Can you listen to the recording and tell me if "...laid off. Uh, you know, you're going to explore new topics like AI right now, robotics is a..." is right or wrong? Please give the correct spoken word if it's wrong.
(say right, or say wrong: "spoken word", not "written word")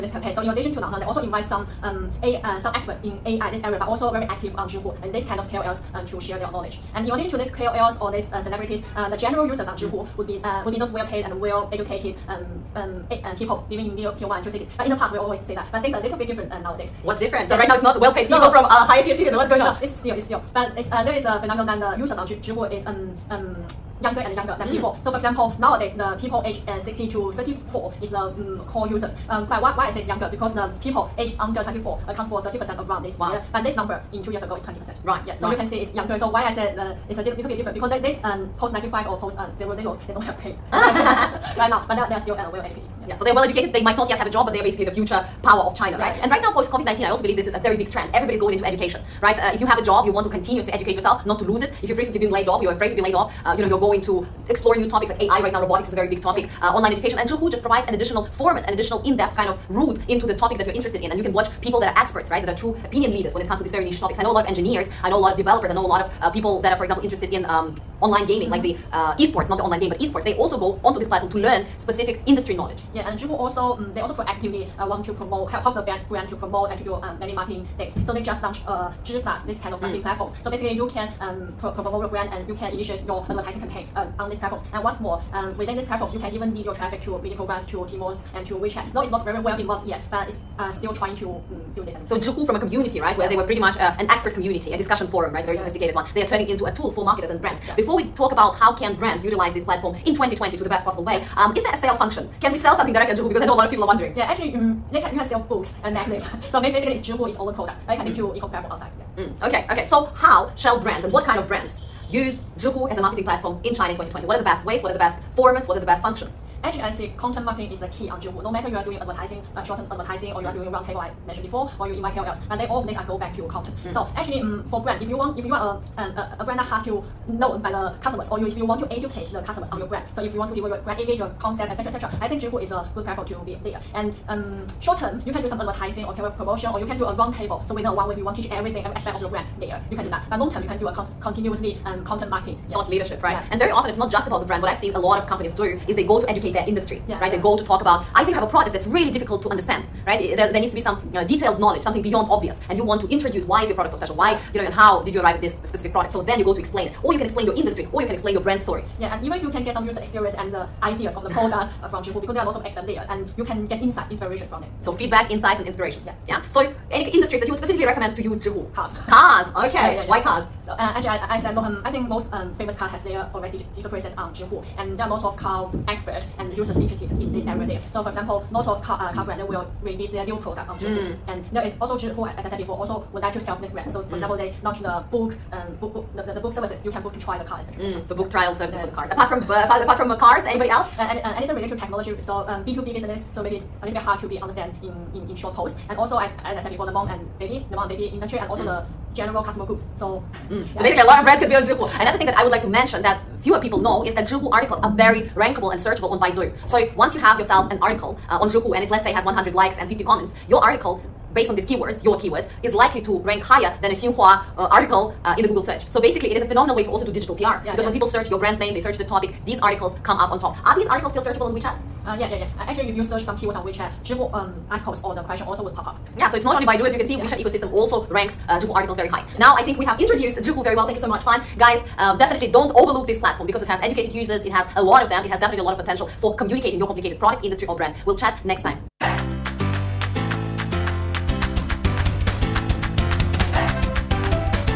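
right.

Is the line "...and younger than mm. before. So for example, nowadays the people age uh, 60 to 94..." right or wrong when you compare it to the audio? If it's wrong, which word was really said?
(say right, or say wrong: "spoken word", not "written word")
wrong: "34", not "94".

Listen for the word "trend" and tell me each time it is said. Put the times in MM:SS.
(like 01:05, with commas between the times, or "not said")
00:47.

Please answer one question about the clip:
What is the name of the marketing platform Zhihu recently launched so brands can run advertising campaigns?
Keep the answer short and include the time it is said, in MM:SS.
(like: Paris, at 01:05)
Zhi Plus, at 01:19.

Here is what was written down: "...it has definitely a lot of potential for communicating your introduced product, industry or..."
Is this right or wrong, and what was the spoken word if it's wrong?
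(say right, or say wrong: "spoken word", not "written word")
wrong: "complicated", not "introduced".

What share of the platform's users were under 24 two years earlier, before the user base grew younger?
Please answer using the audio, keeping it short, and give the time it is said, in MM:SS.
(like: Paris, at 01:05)
20%, at 00:34.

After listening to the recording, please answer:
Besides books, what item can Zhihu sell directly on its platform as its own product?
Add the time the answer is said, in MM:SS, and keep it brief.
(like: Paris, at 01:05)
magnets, at 01:45.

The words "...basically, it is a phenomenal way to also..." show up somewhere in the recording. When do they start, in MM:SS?
03:36.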